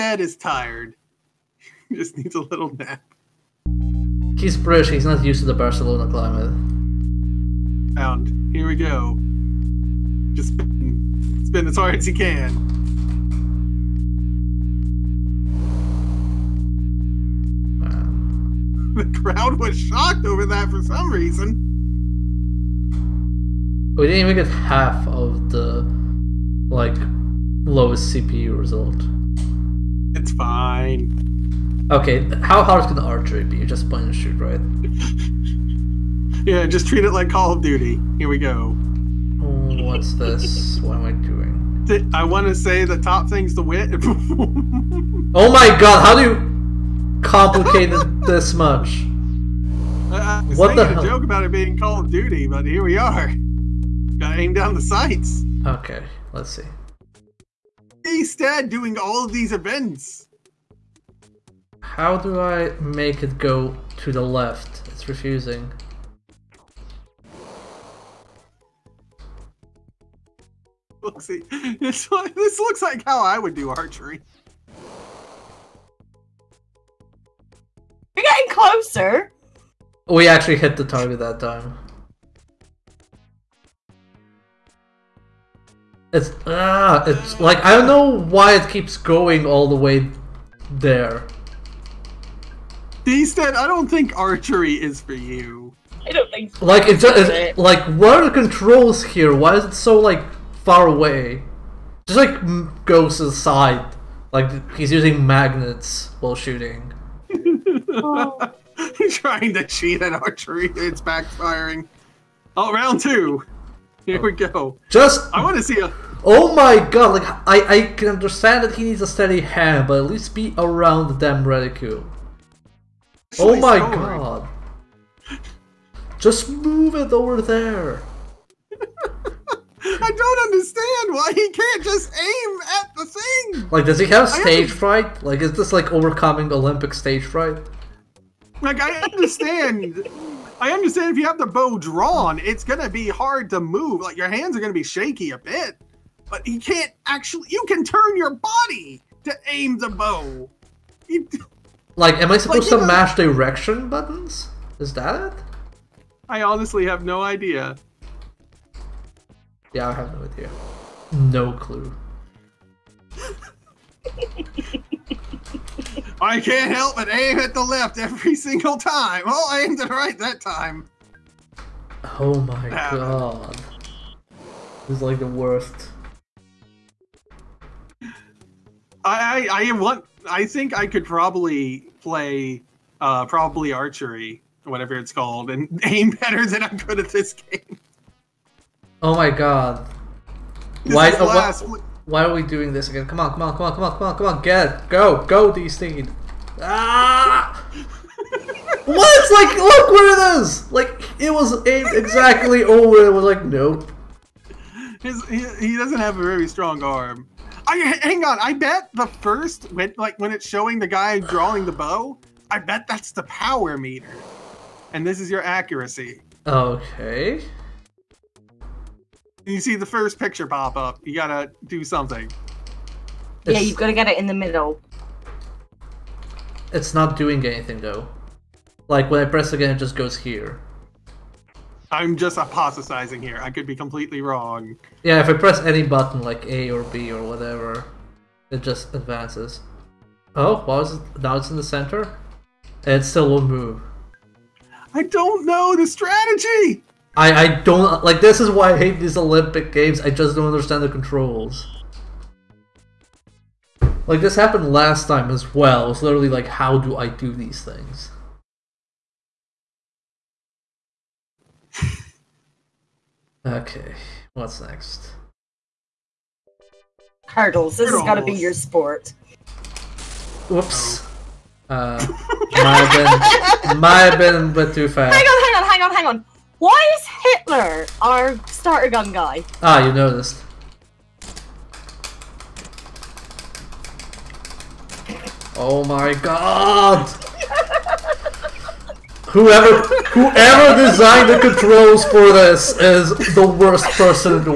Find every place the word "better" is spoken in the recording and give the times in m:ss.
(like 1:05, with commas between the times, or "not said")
3:06.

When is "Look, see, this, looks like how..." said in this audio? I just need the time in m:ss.
1:11.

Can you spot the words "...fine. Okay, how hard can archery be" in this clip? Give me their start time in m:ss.
0:30.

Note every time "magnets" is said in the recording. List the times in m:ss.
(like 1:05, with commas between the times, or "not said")
1:45.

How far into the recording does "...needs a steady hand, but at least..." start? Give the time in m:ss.
1:58.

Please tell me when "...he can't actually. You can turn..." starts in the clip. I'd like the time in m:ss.
2:26.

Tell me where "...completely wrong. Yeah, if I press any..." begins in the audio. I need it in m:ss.
3:53.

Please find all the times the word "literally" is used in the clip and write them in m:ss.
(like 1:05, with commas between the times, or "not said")
4:16.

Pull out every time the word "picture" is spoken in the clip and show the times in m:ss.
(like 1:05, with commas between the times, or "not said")
3:40.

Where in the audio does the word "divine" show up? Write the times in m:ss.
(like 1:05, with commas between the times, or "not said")
not said.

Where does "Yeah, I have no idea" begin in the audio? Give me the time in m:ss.
2:39.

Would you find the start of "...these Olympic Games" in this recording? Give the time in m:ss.
4:09.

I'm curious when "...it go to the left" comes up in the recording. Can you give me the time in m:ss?
1:03.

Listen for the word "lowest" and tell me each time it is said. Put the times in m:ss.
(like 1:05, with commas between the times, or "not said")
0:27.